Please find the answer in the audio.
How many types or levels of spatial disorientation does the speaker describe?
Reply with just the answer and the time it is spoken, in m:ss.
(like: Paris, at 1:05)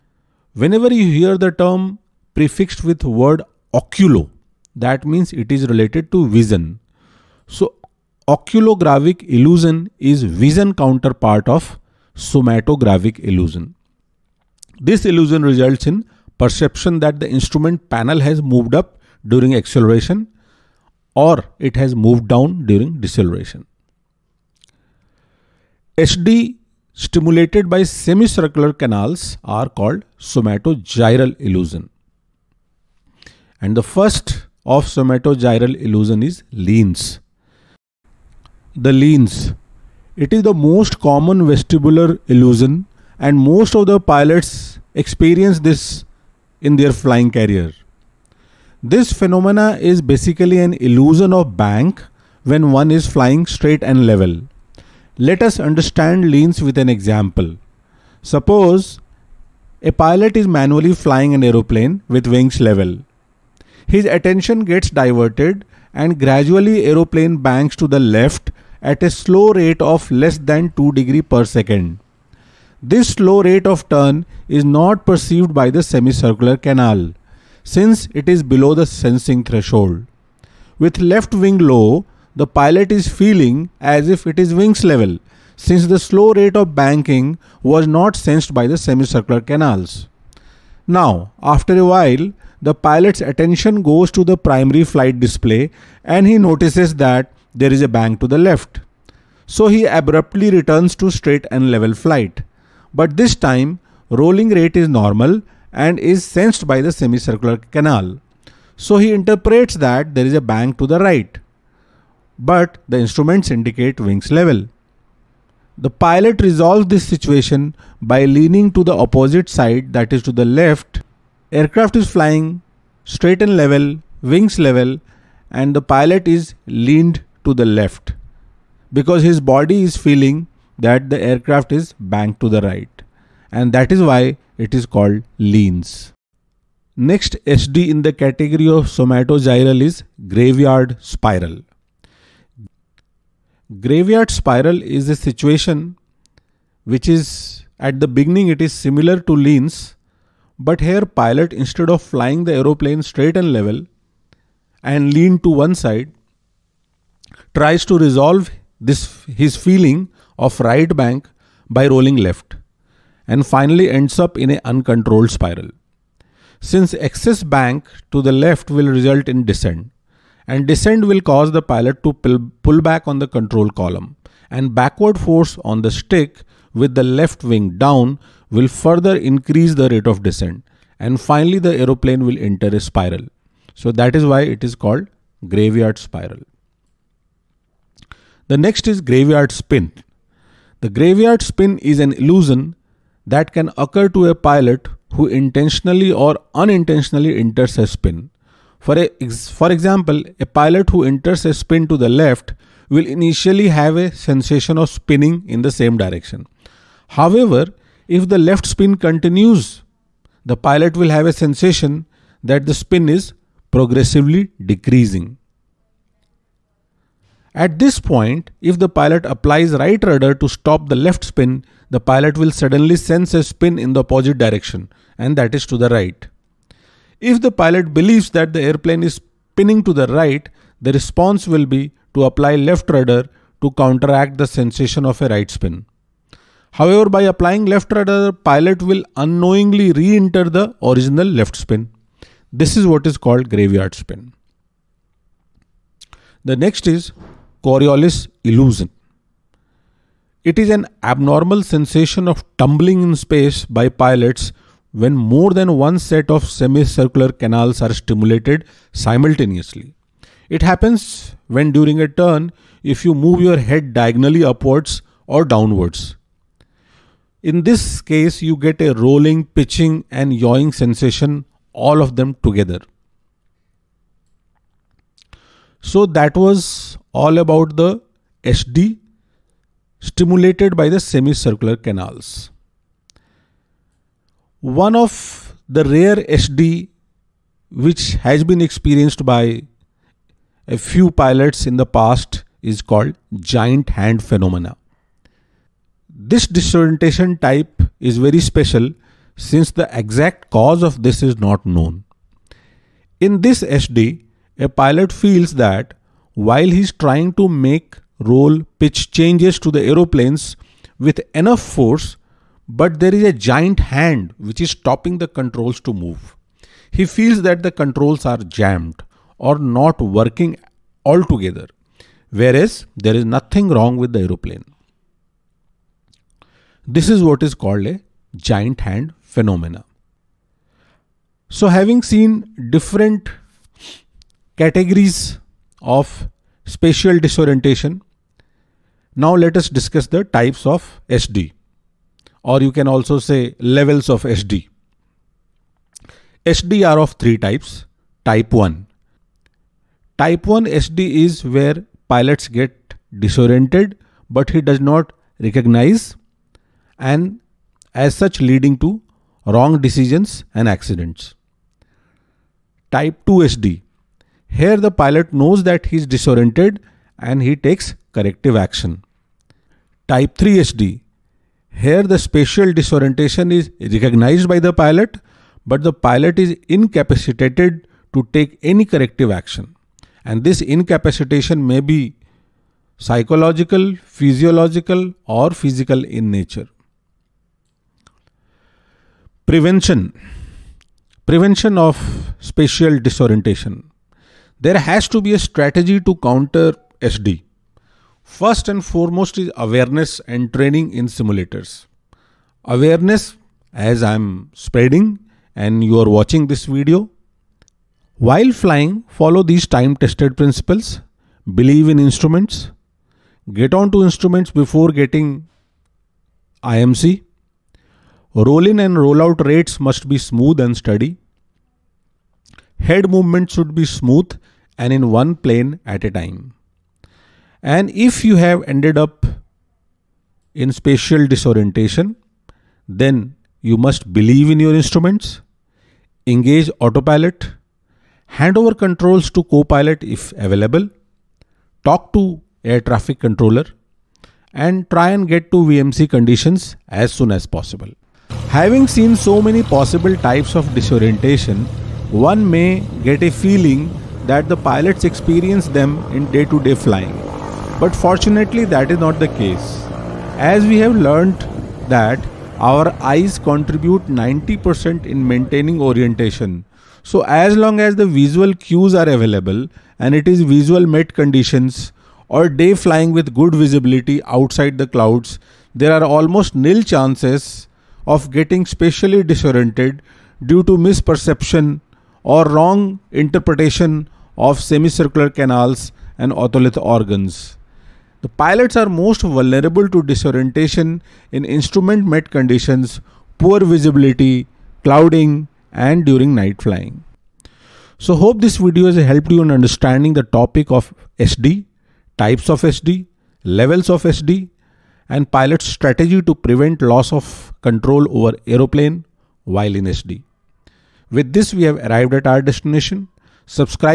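3, at 5:47.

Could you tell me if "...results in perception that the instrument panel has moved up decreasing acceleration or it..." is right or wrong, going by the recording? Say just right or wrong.
wrong.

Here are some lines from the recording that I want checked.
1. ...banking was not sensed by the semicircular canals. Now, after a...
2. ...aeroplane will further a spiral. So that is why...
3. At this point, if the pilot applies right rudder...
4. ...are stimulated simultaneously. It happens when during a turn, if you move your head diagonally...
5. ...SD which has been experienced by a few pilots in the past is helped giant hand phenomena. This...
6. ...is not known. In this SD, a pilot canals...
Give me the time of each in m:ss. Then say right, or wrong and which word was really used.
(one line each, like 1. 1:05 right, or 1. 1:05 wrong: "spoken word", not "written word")
1. 1:26 right
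2. 3:01 wrong: "enter", not "further"
3. 3:37 right
4. 4:17 right
5. 4:46 wrong: "called", not "helped"
6. 5:01 wrong: "feels", not "canals".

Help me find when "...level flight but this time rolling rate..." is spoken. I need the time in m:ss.
1:41.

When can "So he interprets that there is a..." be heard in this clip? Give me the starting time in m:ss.
1:48.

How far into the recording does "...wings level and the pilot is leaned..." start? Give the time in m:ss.
2:04.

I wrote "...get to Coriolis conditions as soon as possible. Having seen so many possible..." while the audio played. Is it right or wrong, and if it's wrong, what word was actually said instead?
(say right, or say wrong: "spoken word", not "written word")
wrong: "VMC", not "Coriolis".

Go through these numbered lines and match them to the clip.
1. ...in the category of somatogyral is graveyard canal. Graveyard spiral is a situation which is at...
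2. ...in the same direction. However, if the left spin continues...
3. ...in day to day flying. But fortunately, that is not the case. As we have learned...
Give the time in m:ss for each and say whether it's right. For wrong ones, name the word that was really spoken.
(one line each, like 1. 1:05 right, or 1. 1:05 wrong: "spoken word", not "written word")
1. 2:17 wrong: "spiral", not "canal"
2. 3:25 right
3. 7:36 right.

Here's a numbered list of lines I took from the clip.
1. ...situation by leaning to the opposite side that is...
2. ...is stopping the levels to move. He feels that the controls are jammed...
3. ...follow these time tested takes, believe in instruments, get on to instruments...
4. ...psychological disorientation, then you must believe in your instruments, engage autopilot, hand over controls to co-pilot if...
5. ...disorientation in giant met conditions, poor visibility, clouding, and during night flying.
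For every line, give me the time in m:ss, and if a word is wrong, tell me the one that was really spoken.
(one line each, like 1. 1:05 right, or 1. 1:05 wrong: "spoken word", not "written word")
1. 1:57 right
2. 5:14 wrong: "controls", not "levels"
3. 6:49 wrong: "principles", not "takes"
4. 7:10 wrong: "spatial", not "psychological"
5. 8:10 wrong: "instrument", not "giant".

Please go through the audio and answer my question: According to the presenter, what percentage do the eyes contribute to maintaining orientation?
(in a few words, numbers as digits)
90%.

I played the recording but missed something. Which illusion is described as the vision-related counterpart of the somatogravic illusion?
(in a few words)
Oculogravic illusion.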